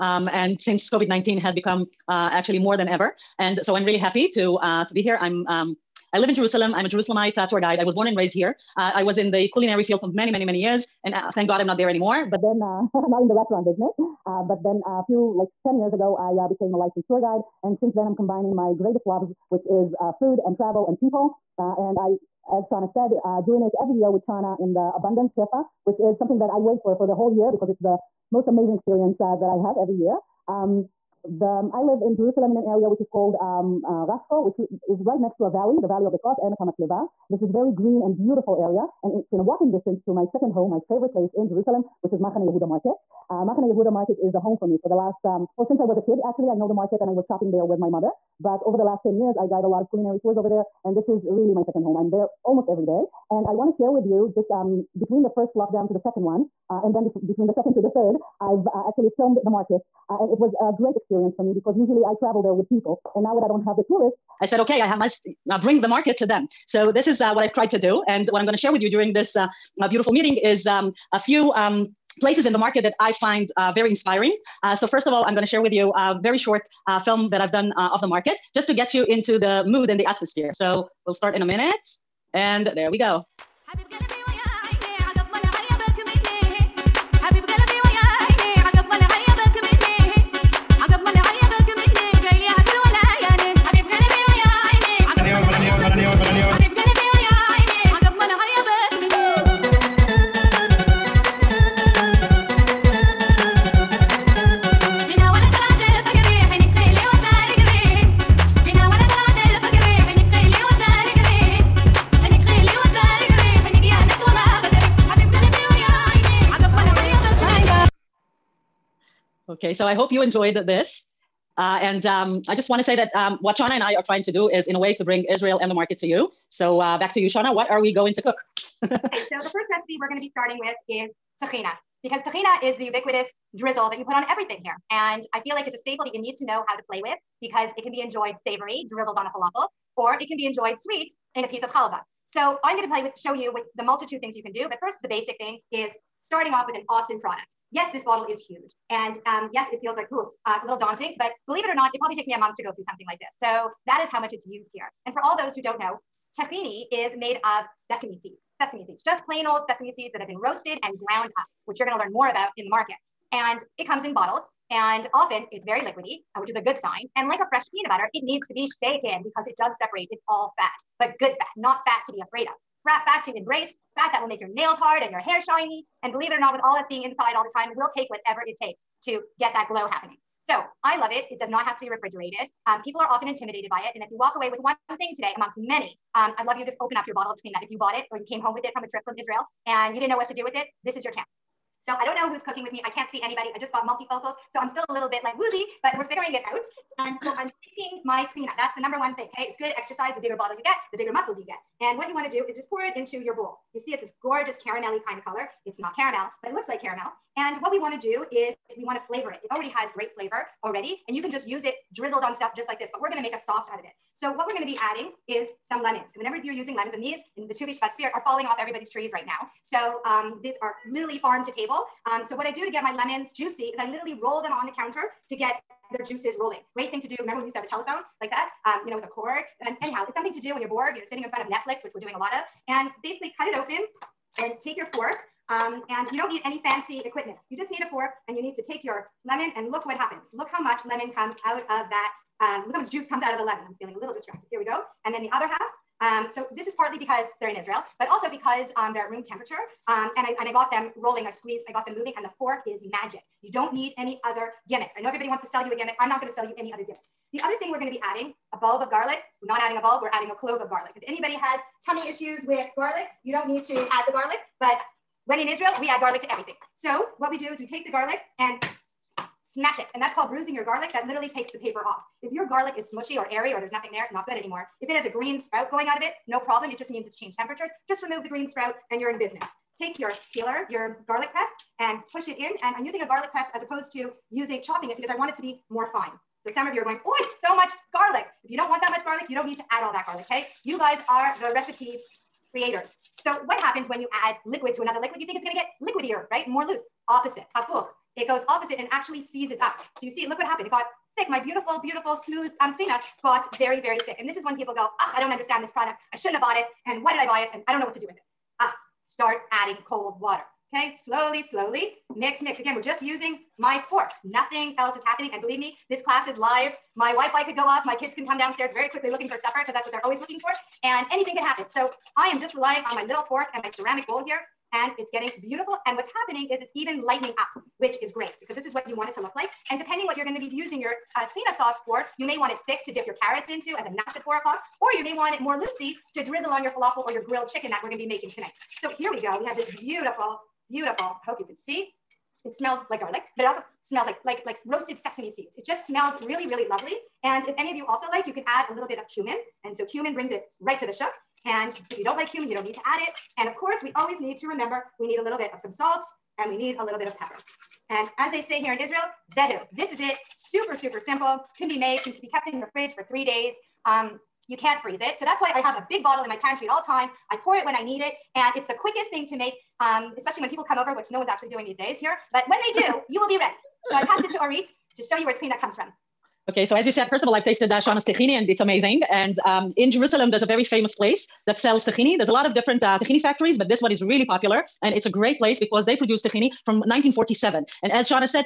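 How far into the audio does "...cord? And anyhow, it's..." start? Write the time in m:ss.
3:49.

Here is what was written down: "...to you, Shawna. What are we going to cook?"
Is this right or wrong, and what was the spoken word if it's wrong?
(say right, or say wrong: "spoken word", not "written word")
right.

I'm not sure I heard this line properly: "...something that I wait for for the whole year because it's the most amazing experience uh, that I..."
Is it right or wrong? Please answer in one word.
right.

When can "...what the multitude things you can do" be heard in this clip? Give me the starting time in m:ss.
2:23.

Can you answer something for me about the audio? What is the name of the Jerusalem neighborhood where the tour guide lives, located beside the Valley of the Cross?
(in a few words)
Rasko.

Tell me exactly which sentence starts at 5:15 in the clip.
And believe me, this class is live.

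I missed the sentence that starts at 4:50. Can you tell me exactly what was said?
You guys are the recipe creators.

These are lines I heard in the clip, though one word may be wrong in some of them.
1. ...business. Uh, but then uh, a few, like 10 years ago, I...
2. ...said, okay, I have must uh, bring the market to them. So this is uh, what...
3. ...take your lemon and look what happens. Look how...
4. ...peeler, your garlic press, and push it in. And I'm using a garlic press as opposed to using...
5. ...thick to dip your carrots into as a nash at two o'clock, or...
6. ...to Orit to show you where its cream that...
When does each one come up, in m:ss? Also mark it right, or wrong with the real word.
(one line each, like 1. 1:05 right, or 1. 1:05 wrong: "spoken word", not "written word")
1. 0:13 right
2. 1:04 right
3. 3:58 right
4. 4:40 right
5. 5:32 wrong: "four", not "two"
6. 6:14 right.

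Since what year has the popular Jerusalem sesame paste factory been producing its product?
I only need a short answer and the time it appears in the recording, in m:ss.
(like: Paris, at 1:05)
1947, at 6:26.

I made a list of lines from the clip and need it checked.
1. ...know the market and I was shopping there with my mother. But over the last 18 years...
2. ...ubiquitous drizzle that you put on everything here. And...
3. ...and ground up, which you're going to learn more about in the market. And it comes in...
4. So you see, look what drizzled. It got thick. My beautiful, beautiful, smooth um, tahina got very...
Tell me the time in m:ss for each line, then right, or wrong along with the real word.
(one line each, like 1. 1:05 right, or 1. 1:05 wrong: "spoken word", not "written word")
1. 0:46 wrong: "10", not "18"
2. 2:12 right
3. 2:40 right
4. 4:59 wrong: "happened", not "drizzled".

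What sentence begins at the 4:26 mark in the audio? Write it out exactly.
So what we do is we take the garlic and smash it.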